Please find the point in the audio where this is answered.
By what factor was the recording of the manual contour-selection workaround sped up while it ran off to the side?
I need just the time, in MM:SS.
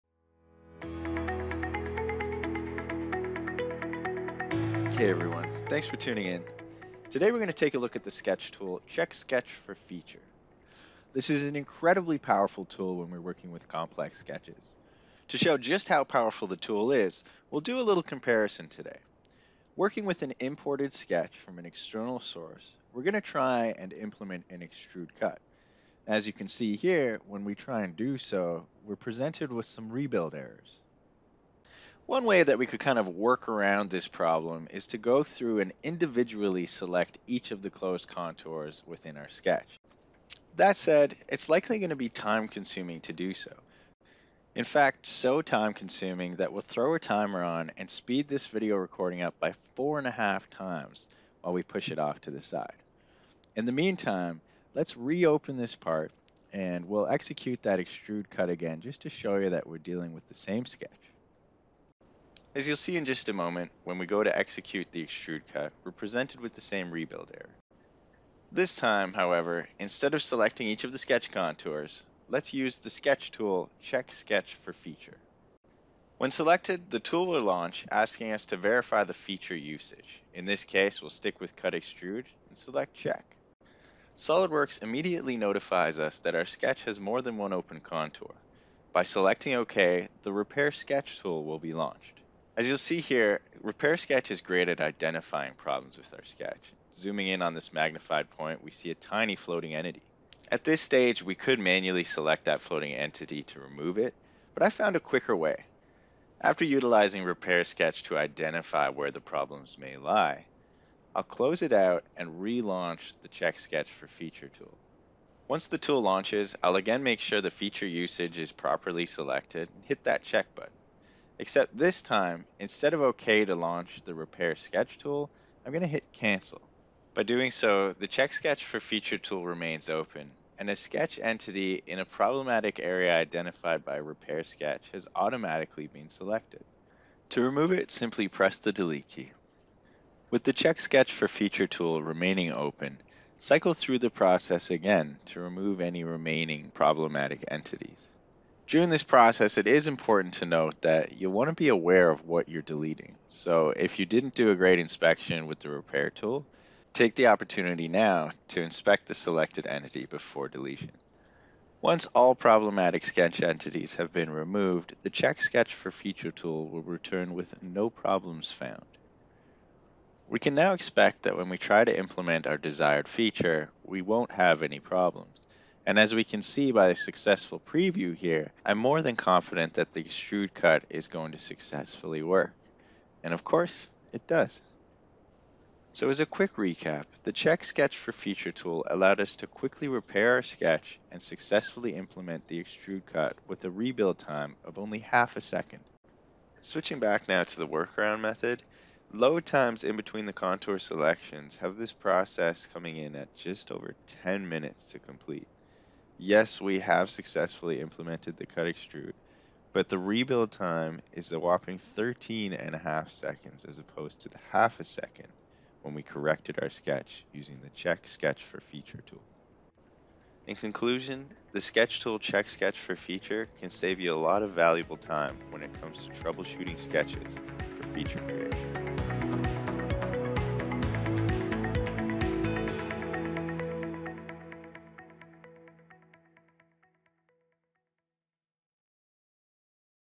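00:49.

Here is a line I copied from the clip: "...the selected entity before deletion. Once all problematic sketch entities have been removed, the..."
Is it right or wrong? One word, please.
right.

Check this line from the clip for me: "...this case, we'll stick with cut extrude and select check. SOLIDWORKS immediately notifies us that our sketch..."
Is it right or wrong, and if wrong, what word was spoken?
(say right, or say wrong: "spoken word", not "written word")
right.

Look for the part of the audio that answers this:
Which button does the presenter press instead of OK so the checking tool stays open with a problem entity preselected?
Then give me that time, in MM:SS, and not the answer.
02:06.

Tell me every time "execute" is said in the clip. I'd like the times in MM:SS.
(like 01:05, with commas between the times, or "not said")
00:57, 01:04.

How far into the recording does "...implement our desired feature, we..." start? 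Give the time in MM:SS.
02:51.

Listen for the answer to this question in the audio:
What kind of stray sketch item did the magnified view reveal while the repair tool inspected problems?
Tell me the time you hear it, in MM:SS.
01:38.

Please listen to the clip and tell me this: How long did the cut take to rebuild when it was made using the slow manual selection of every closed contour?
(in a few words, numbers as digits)
13.5 seconds.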